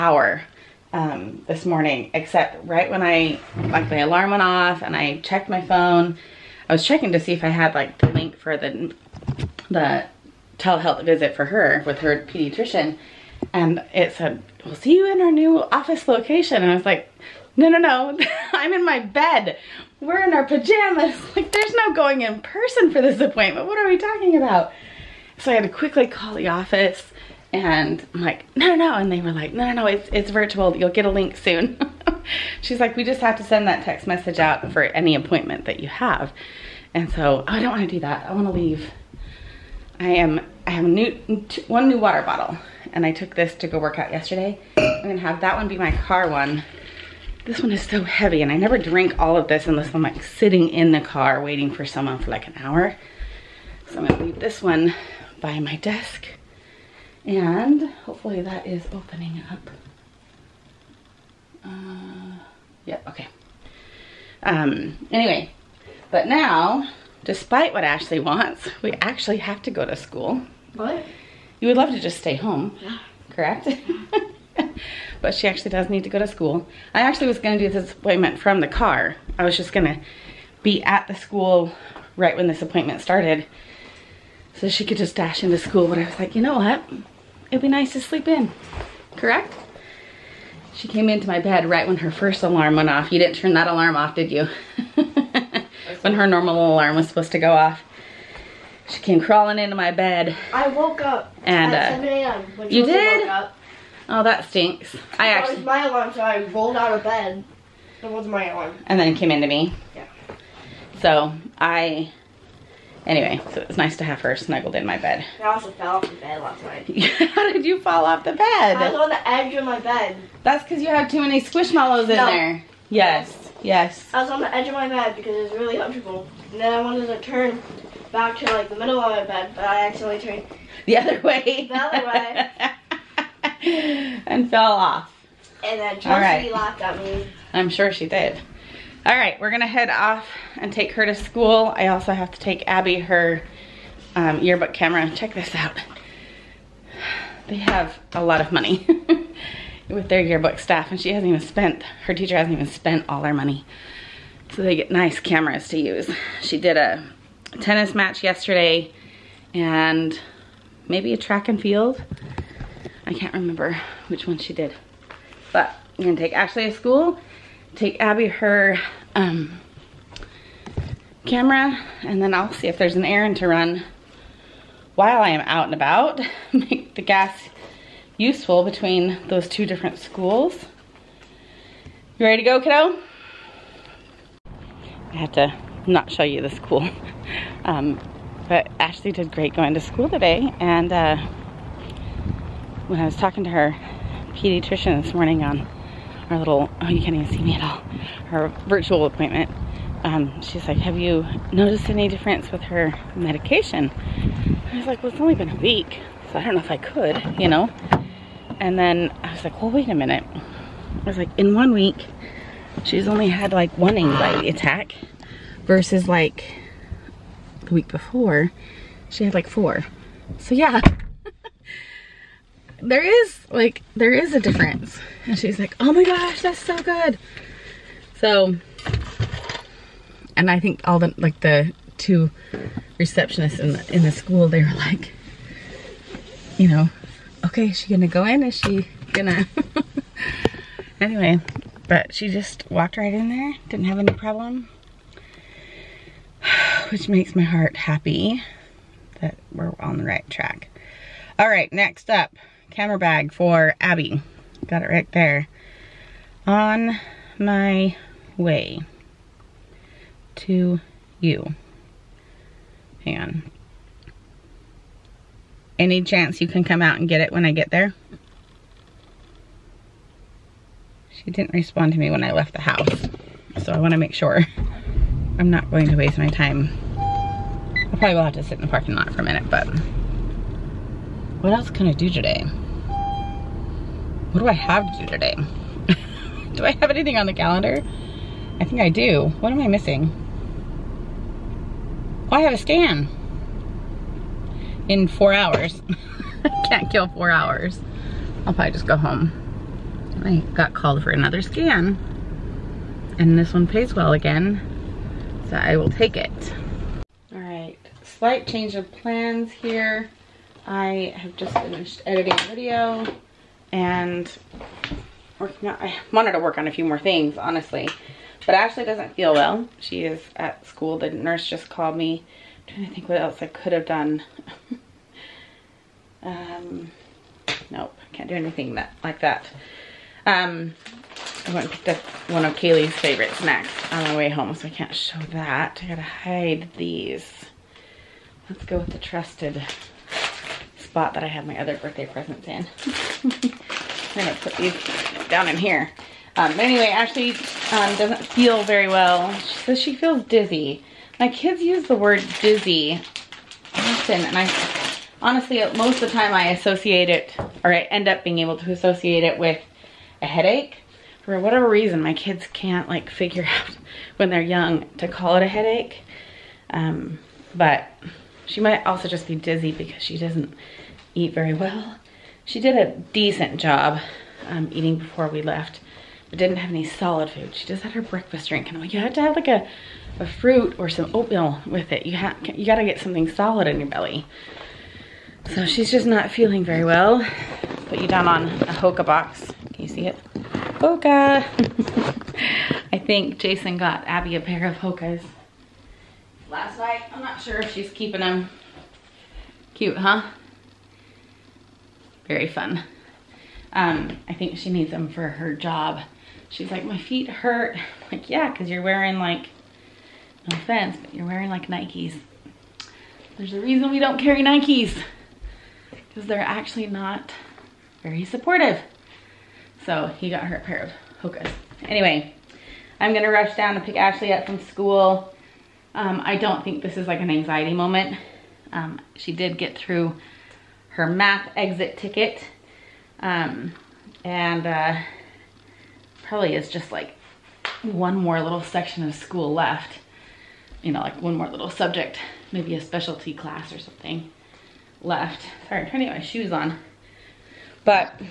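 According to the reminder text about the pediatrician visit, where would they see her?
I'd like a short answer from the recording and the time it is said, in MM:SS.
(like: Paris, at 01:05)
new office location, at 00:15.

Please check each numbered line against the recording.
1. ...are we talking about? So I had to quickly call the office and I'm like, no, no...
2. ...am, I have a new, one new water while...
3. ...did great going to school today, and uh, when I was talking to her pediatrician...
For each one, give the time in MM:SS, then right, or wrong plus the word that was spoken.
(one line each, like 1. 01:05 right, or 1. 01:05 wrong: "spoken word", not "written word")
1. 00:23 right
2. 00:40 wrong: "bottle", not "while"
3. 03:09 right.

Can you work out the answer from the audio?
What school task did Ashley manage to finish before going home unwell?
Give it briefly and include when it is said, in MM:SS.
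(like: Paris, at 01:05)
math exit ticket, at 07:11.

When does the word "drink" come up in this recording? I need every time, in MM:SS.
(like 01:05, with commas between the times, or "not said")
00:48, 06:18.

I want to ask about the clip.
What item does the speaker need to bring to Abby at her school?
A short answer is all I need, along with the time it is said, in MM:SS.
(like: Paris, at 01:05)
yearbook camera, at 02:24.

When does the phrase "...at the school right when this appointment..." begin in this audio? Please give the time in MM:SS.
01:20.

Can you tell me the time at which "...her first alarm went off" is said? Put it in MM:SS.
01:31.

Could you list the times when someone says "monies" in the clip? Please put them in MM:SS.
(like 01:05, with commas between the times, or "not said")
not said.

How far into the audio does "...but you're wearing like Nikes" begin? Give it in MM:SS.
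06:51.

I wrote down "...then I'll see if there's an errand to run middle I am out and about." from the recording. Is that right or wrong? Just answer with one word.
wrong.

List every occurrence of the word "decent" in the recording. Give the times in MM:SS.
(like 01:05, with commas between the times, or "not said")
06:13.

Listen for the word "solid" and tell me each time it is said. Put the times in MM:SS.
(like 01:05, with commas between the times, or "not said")
06:16, 06:23.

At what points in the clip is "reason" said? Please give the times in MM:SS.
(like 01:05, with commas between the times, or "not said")
06:01, 06:53.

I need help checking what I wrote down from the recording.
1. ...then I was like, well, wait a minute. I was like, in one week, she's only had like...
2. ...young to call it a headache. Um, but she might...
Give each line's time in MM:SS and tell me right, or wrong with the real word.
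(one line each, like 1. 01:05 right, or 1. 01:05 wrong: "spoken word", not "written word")
1. 03:28 right
2. 06:04 right.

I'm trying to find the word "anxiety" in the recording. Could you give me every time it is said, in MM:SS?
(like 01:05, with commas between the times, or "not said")
03:33, 07:07.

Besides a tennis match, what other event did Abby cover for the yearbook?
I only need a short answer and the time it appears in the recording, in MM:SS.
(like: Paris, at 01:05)
track and field, at 02:41.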